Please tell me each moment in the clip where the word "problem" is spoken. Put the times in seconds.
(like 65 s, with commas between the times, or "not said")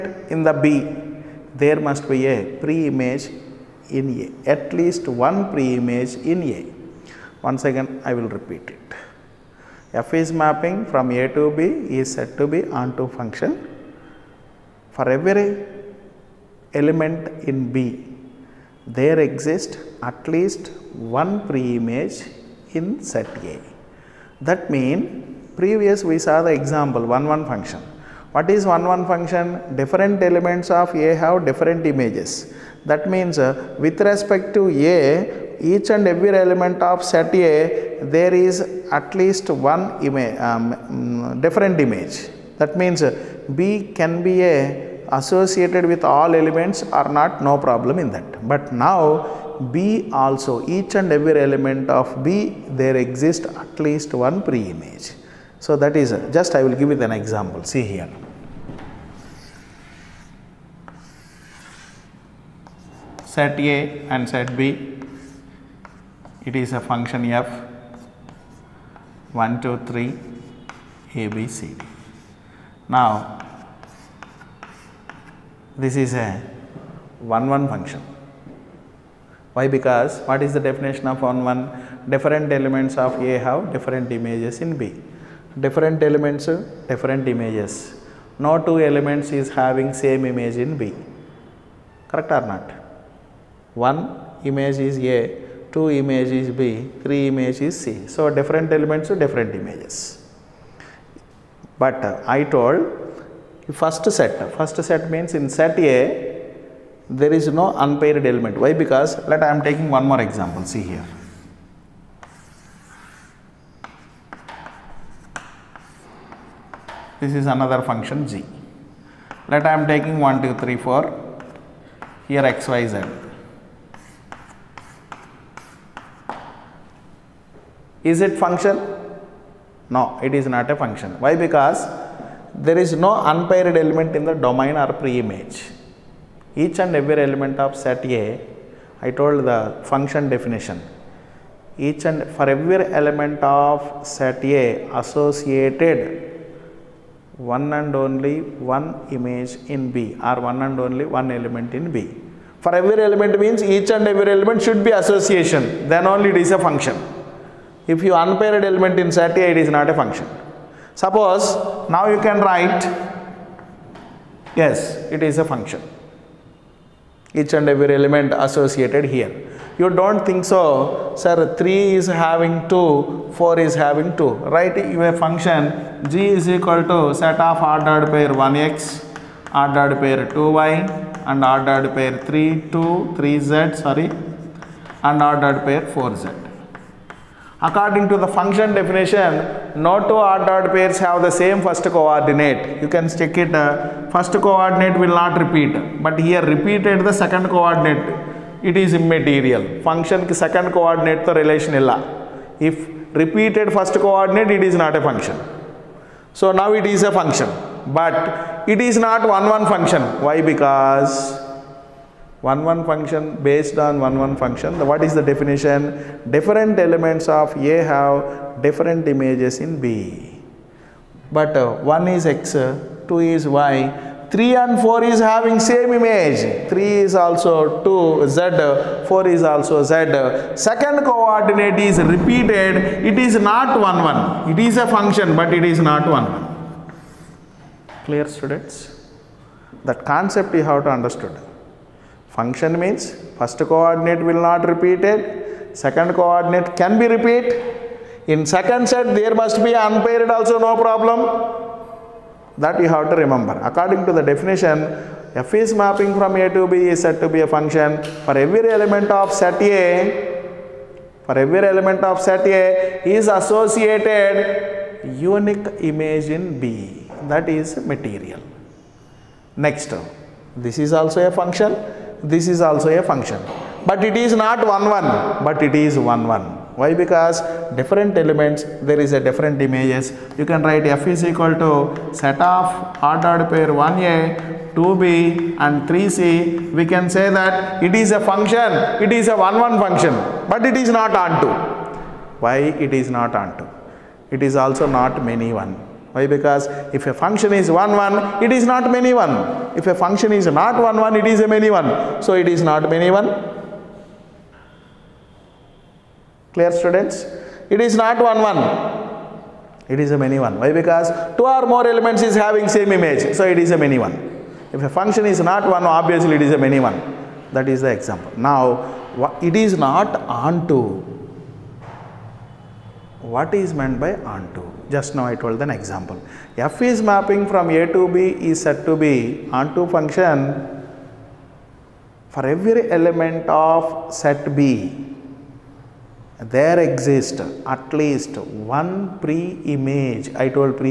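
47 s, 250 s.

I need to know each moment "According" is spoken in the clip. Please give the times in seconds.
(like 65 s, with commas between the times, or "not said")
187 s, 253 s.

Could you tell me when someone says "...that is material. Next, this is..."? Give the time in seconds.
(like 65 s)
267 s.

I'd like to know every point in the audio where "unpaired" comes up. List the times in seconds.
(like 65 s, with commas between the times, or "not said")
107 s, 133 s, 158 s, 249 s.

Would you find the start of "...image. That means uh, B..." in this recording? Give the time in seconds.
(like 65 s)
41 s.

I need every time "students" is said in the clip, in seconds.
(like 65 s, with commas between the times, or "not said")
238 s, 306 s.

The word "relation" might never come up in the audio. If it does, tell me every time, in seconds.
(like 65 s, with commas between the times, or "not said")
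201 s.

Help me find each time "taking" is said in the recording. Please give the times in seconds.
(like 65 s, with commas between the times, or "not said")
109 s, 119 s.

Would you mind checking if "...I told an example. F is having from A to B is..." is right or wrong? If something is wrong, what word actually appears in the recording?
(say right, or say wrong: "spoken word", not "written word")
wrong: "mapping", not "having".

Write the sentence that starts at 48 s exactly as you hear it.
But now B also, each and every element of B, there exists at least one pre-image.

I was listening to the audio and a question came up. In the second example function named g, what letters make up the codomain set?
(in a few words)
x, y, z.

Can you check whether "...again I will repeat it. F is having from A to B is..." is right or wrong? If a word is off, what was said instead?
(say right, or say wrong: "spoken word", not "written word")
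wrong: "mapping", not "having".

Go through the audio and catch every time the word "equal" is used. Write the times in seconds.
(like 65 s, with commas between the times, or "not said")
176 s, 281 s.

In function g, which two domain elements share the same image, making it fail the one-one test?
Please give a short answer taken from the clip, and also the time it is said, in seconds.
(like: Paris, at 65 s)
3 and 4, at 224 s.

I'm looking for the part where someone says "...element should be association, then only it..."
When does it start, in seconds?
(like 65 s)
154 s.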